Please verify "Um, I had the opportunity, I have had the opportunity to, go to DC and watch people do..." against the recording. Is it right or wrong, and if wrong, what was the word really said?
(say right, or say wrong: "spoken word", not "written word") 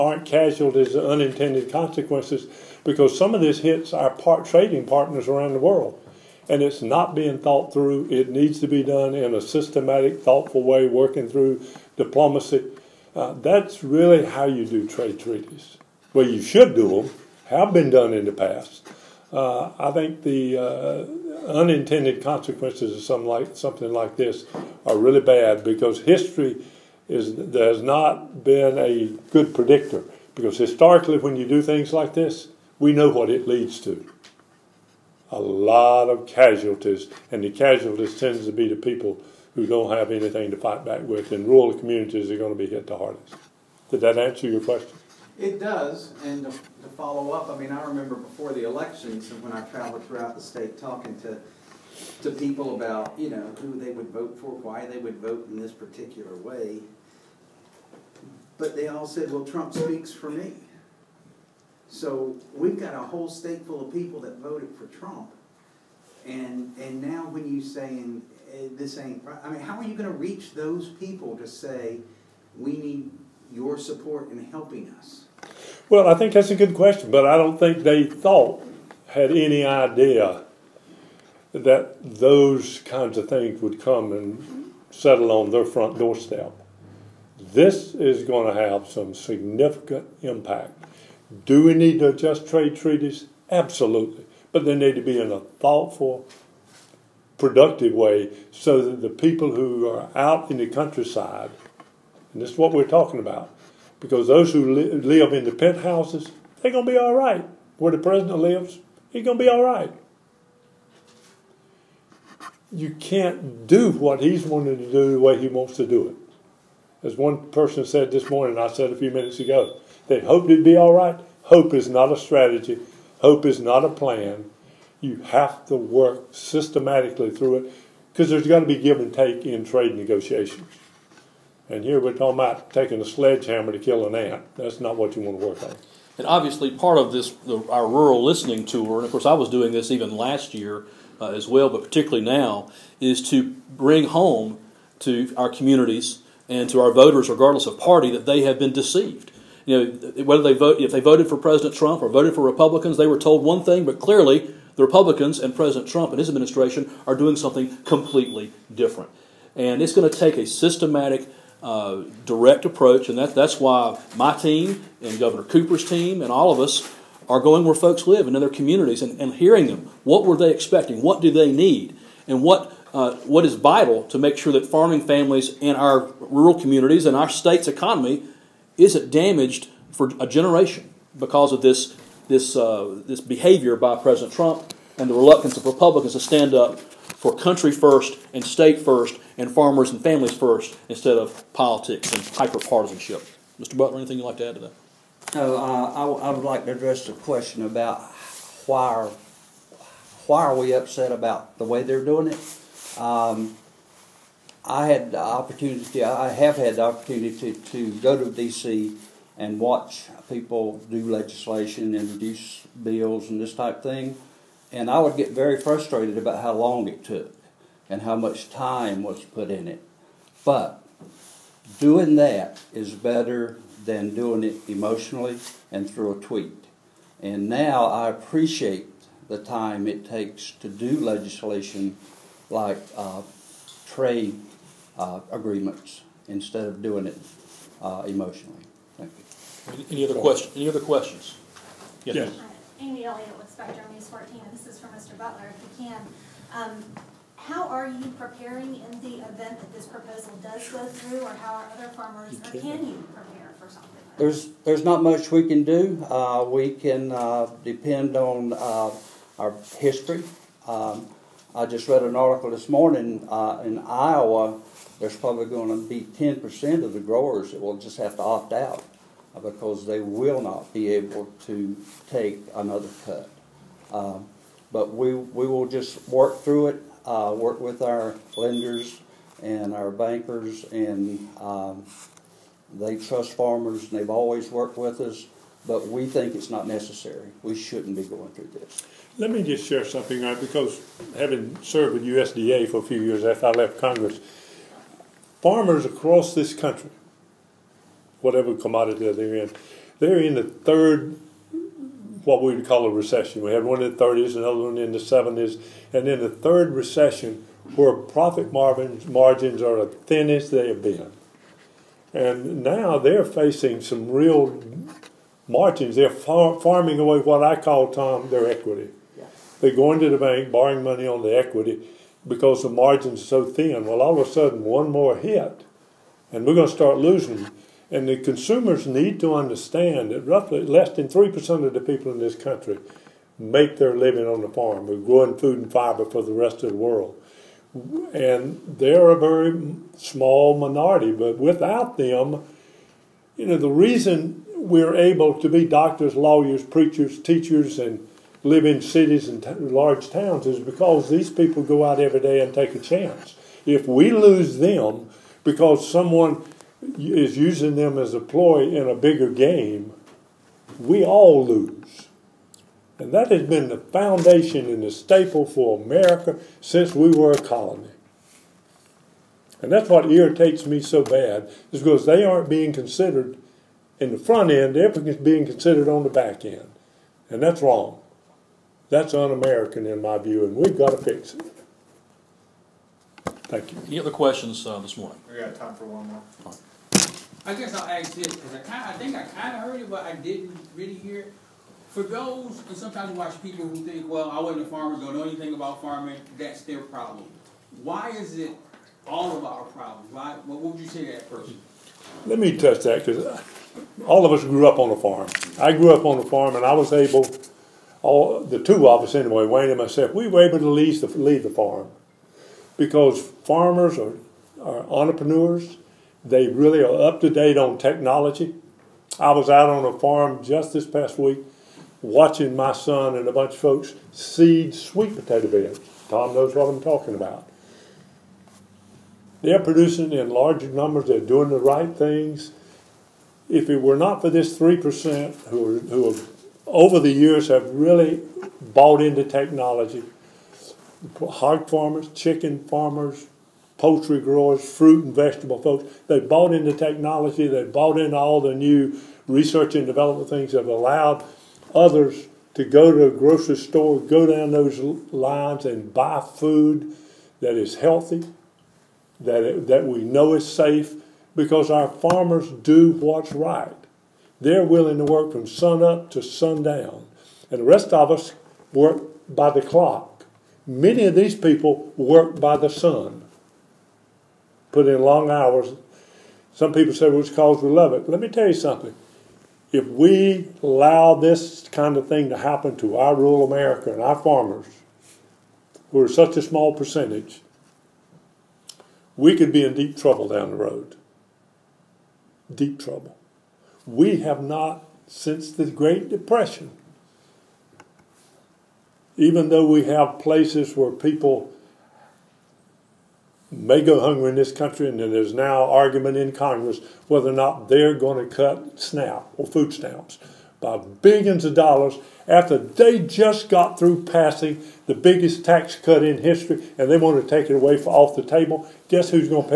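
right.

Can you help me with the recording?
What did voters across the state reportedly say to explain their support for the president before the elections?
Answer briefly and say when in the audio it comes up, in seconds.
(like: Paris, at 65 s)
Trump speaks for me, at 59 s.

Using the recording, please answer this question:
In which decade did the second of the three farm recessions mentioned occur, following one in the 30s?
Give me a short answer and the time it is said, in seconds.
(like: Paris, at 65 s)
the 70s, at 304 s.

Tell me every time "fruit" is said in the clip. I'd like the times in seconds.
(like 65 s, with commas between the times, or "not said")
444 s.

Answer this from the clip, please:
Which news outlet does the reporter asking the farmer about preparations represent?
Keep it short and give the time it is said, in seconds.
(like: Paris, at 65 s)
Spectrum News 14, at 243 s.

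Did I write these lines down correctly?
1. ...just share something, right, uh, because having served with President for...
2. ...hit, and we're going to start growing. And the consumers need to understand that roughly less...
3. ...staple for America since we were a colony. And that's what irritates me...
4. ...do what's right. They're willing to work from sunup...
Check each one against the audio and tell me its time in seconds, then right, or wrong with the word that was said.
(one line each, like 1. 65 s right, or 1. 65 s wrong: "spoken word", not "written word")
1. 289 s wrong: "USDA", not "President"
2. 325 s wrong: "losing", not "growing"
3. 364 s right
4. 462 s right.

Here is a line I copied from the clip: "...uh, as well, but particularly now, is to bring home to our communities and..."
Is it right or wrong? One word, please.
right.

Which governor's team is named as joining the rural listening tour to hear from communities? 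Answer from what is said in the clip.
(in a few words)
Governor Cooper.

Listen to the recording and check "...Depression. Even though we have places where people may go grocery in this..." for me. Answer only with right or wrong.
wrong.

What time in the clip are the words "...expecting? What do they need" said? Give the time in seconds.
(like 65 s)
170 s.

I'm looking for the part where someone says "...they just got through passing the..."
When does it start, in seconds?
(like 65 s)
512 s.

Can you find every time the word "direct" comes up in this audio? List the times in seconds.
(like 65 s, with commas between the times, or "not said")
162 s.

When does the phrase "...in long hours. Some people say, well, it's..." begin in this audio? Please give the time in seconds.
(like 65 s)
474 s.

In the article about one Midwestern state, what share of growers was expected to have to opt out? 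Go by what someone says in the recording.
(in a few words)
10%.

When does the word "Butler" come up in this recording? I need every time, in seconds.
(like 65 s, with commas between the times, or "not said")
193 s, 245 s.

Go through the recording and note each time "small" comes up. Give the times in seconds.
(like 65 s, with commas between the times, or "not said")
339 s, 486 s.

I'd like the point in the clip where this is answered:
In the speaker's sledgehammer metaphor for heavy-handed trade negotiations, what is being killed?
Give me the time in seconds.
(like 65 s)
134 s.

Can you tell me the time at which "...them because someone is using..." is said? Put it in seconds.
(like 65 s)
354 s.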